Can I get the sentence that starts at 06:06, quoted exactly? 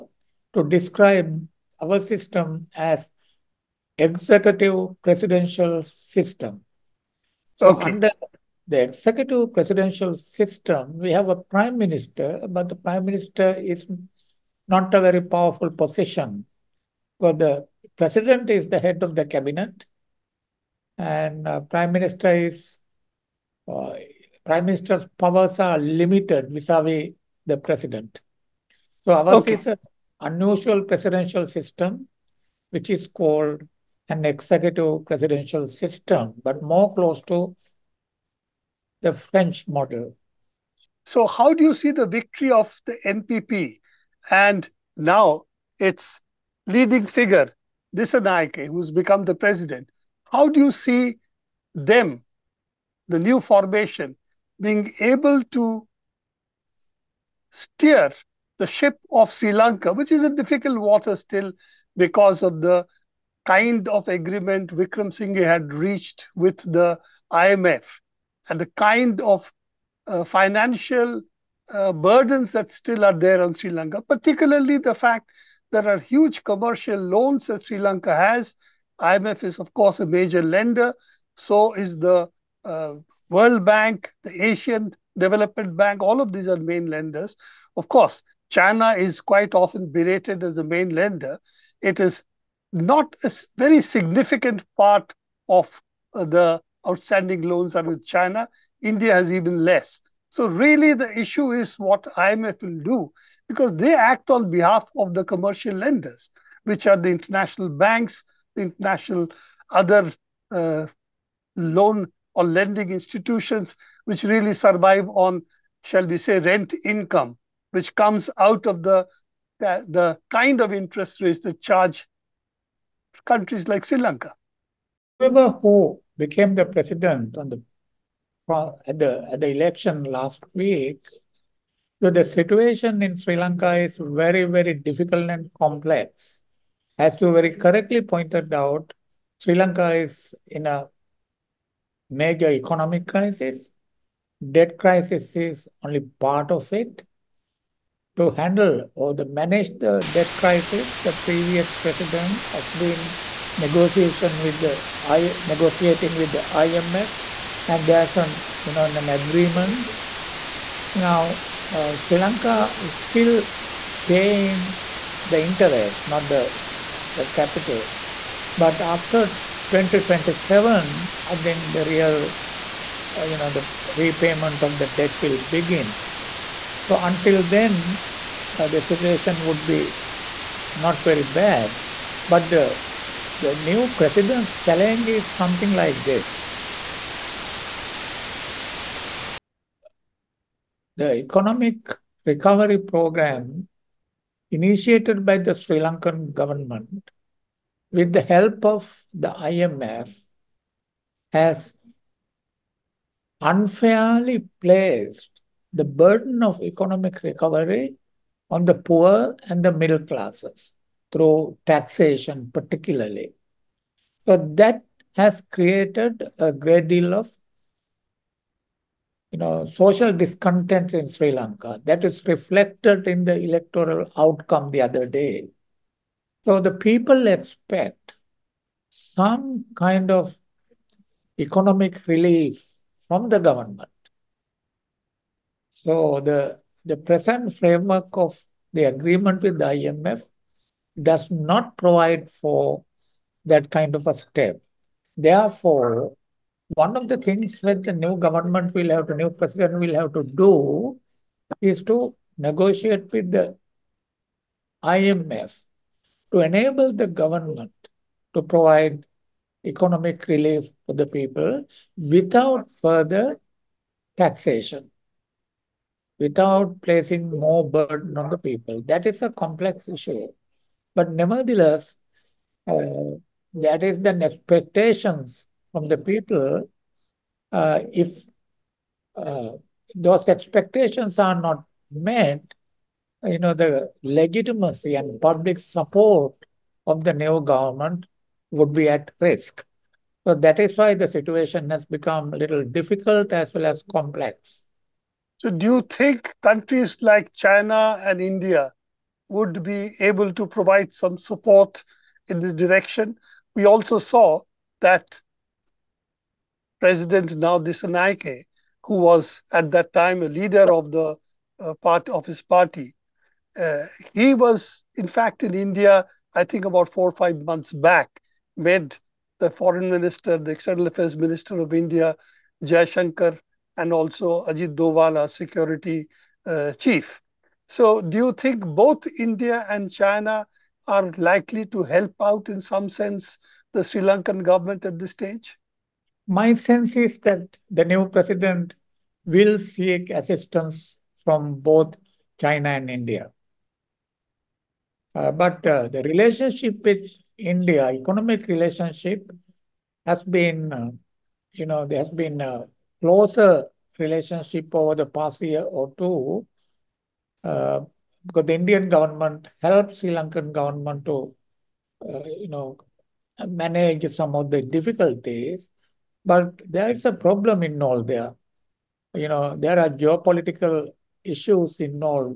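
But there is a problem involved there.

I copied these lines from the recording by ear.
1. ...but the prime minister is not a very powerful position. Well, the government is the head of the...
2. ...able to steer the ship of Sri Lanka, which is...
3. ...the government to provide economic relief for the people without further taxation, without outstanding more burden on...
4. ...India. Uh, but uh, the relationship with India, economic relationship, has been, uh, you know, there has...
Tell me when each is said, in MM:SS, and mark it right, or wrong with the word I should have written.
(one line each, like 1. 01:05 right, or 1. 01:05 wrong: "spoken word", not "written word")
1. 00:12 wrong: "president", not "government"
2. 00:55 right
3. 04:16 wrong: "placing", not "outstanding"
4. 05:42 right.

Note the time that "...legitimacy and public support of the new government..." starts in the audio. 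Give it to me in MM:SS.
04:44.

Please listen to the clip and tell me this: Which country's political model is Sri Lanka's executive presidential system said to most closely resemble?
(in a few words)
French model.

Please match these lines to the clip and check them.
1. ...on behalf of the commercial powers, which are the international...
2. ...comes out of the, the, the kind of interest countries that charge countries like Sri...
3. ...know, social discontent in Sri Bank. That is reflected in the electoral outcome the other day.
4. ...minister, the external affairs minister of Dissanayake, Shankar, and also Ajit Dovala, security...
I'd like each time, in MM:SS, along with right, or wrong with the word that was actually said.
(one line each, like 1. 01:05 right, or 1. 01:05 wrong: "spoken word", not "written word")
1. 01:44 wrong: "lenders", not "powers"
2. 01:57 wrong: "rates", not "countries"
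3. 03:39 wrong: "Lanka", not "Bank"
4. 05:19 wrong: "India", not "Dissanayake".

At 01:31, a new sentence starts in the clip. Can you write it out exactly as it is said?
It is not a very significant part of uh, the outstanding loans are with China.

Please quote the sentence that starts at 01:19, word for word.
IMF is, of course, a major lender.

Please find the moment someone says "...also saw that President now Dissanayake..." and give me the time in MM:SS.
05:03.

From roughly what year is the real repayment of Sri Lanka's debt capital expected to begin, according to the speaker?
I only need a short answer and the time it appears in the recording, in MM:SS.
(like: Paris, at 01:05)
2027, at 02:49.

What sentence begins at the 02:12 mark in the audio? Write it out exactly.
So the situation in Sri Lanka is very very difficult and complex.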